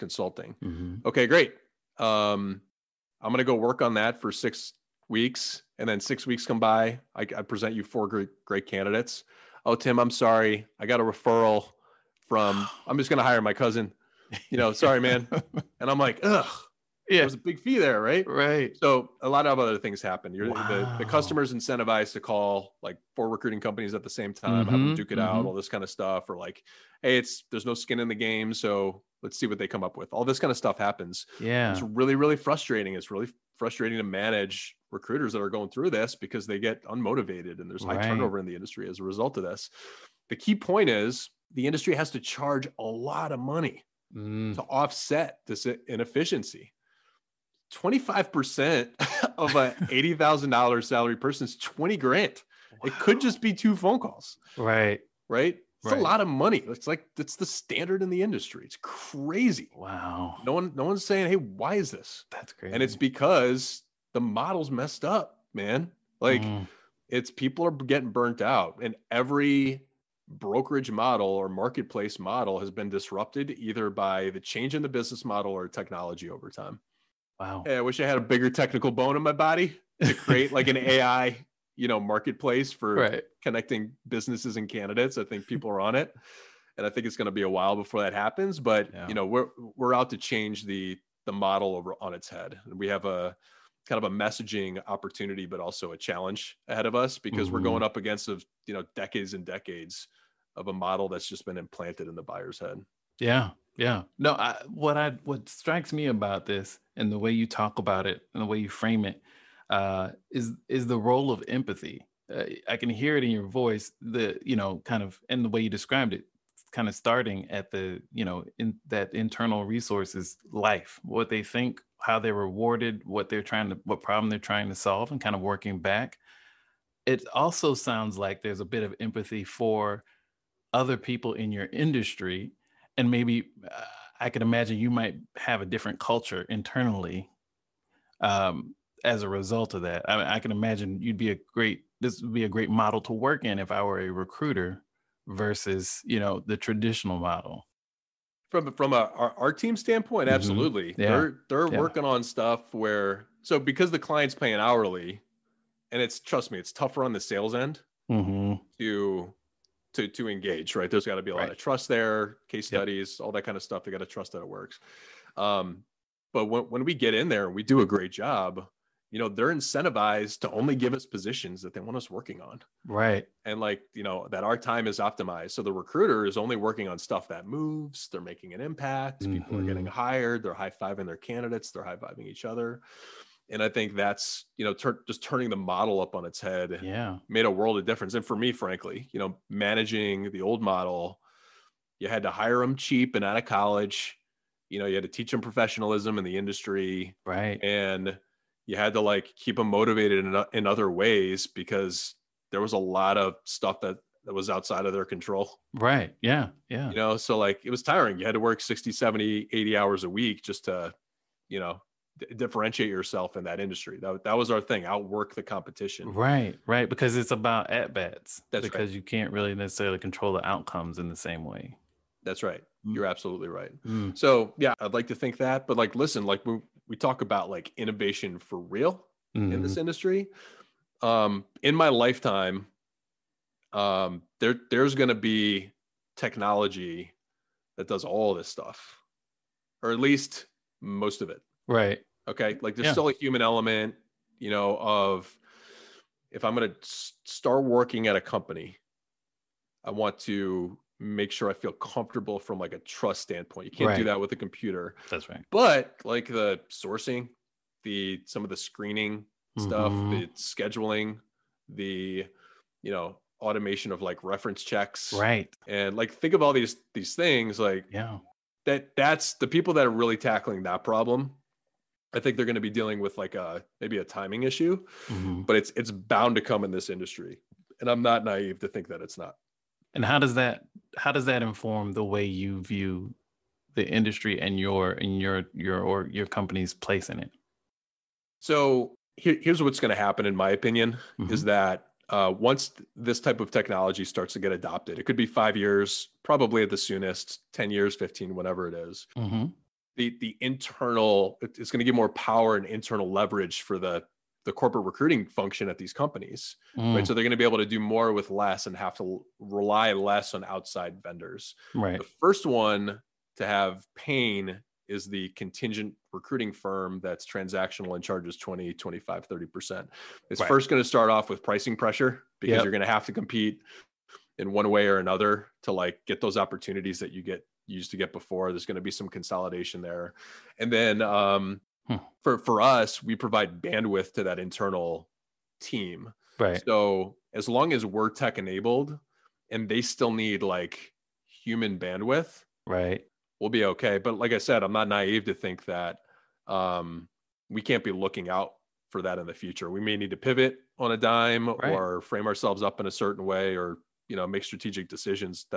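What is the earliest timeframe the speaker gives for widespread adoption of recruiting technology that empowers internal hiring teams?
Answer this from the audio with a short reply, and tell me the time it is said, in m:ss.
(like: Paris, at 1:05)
5 years, at 4:55.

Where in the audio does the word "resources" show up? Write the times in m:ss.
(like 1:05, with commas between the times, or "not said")
1:59.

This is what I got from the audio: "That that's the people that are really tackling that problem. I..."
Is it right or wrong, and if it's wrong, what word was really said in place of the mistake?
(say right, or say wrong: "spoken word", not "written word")
right.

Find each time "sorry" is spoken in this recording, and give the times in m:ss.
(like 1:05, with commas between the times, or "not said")
0:10, 0:14.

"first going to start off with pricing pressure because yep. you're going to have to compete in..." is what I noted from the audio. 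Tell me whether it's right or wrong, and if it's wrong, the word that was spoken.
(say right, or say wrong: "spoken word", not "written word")
right.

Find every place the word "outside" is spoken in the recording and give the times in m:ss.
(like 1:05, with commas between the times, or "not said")
3:24, 5:10.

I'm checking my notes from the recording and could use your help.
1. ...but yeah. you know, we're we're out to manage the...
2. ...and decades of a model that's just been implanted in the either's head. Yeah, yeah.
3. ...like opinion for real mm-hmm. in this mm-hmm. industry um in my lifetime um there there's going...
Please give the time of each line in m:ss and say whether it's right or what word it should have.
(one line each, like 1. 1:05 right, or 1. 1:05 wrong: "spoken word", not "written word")
1. 1:28 wrong: "change", not "manage"
2. 1:39 wrong: "buyer", not "either"
3. 3:47 wrong: "innovation", not "opinion".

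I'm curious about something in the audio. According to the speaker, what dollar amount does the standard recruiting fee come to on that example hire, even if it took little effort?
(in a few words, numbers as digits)
20 grand.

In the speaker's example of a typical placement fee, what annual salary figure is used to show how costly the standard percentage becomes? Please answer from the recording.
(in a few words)
$80,000.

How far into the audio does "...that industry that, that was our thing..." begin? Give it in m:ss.
3:33.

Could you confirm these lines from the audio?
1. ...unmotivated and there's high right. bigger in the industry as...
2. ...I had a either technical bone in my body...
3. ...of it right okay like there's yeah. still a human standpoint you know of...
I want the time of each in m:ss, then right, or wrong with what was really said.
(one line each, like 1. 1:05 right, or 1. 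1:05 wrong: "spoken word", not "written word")
1. 0:36 wrong: "turnover", not "bigger"
2. 1:18 wrong: "bigger", not "either"
3. 4:01 wrong: "element", not "standpoint".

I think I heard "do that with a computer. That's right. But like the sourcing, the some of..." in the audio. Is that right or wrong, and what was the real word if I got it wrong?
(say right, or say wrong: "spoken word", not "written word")
right.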